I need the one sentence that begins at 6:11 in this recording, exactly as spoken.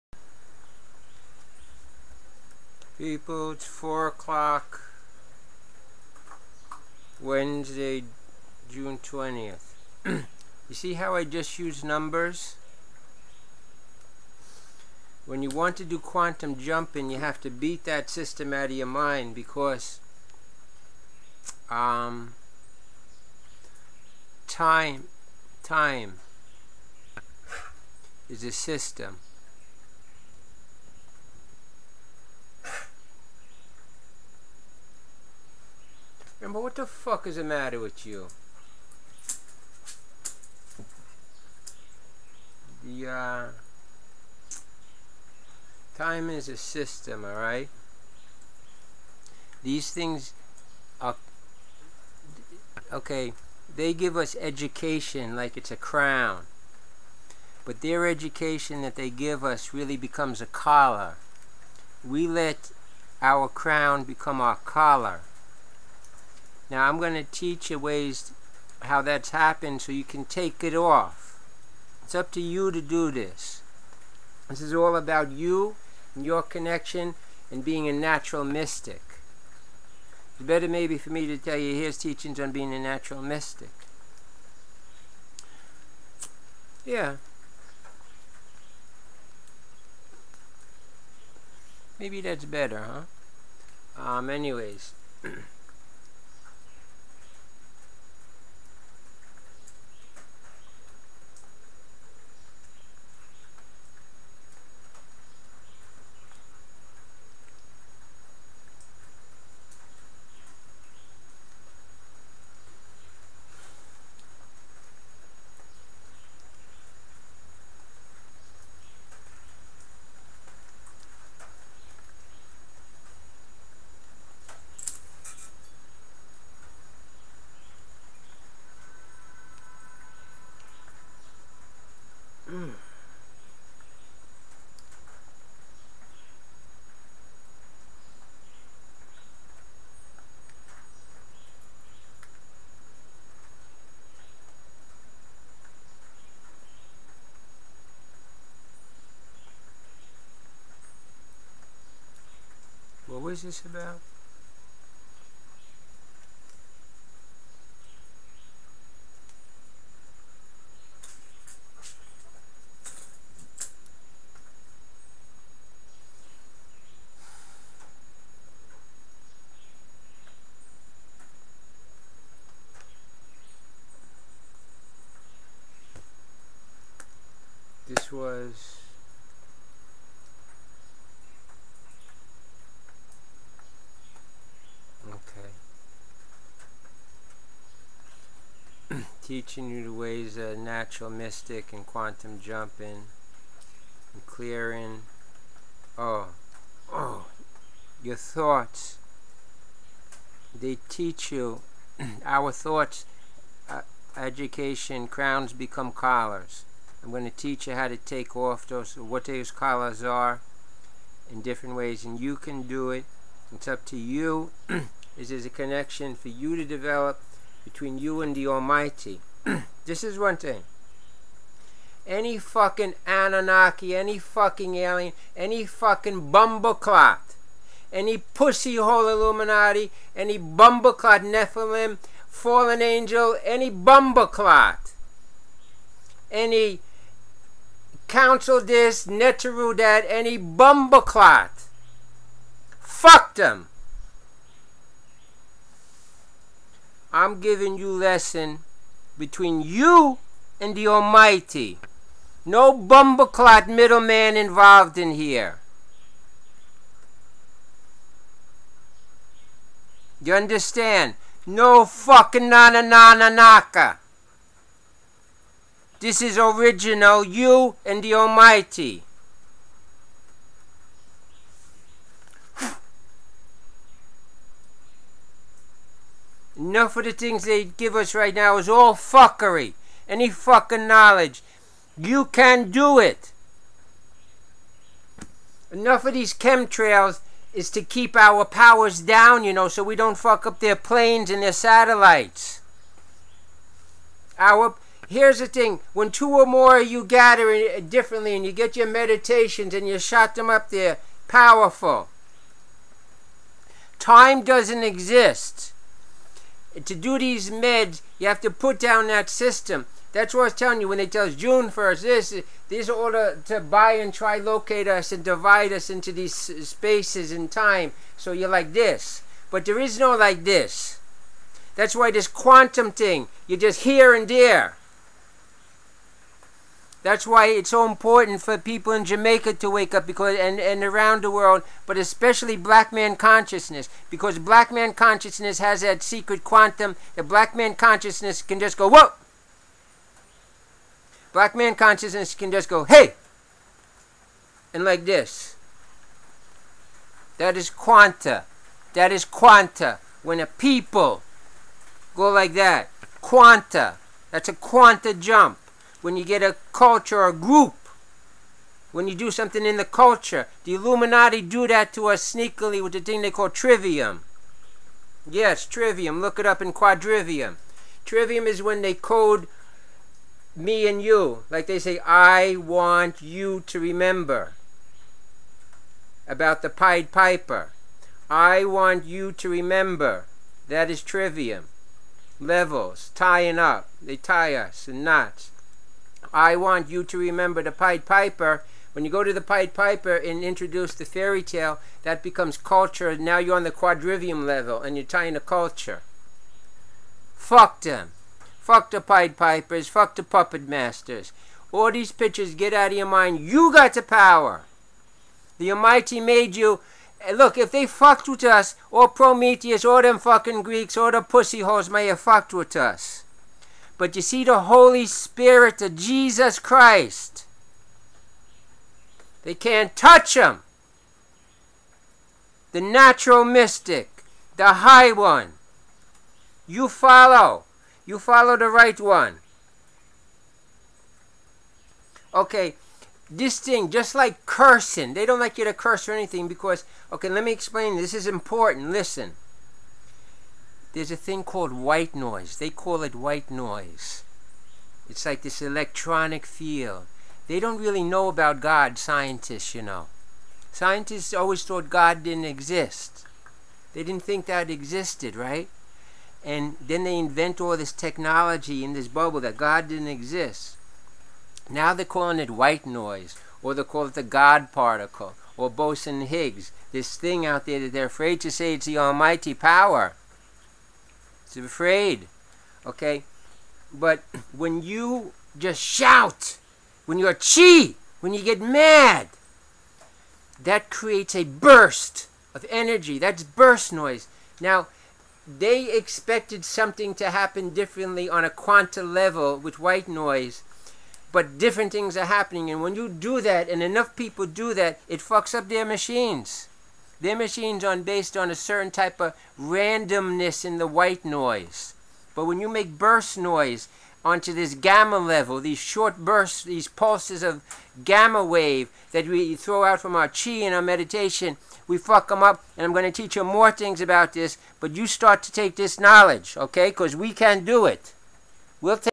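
Like they say, I want you to remember about the Pied Piper.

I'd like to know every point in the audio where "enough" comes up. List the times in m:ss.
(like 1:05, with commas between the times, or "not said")
4:36, 4:45, 8:13.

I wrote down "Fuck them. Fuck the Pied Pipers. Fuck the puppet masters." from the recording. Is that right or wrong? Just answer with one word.
right.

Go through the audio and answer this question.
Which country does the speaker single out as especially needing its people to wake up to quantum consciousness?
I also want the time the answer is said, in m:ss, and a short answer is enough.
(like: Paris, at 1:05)
Jamaica, at 5:29.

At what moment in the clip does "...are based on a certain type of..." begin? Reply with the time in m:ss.
8:17.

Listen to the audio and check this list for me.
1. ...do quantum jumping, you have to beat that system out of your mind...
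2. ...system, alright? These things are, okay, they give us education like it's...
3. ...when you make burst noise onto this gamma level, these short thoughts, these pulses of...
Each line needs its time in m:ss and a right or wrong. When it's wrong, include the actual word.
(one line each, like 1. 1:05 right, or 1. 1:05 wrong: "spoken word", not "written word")
1. 0:15 right
2. 0:46 right
3. 8:22 wrong: "bursts", not "thoughts".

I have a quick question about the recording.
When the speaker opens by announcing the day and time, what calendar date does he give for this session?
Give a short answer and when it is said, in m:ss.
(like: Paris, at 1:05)
June 20th, at 0:08.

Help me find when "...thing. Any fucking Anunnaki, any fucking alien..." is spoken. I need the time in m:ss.
3:40.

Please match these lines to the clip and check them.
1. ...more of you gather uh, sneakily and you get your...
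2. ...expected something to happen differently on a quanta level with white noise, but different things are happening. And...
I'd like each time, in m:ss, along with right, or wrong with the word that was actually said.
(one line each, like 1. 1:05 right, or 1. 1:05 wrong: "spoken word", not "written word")
1. 4:56 wrong: "differently", not "sneakily"
2. 8:05 right.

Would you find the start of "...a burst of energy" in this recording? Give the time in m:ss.
8:01.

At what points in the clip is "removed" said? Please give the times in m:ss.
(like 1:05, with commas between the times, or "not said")
not said.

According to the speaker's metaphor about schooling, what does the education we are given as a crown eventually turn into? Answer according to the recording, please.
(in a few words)
A collar.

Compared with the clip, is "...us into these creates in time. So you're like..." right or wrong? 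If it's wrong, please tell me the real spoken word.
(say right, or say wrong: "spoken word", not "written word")
wrong: "spaces", not "creates".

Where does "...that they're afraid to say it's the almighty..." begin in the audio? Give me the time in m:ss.
7:47.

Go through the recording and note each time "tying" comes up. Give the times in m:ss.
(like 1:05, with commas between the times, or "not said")
6:23, 6:35.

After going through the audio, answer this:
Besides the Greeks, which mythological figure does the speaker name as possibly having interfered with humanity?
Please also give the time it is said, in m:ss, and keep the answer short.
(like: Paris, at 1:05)
Prometheus, at 6:49.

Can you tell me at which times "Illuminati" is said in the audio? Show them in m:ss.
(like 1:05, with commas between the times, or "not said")
3:49, 6:00.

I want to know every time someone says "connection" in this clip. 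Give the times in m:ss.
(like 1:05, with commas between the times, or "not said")
1:16, 3:35.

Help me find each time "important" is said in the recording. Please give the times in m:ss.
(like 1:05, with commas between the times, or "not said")
5:27, 7:18.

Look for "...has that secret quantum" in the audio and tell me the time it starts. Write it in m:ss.
5:35.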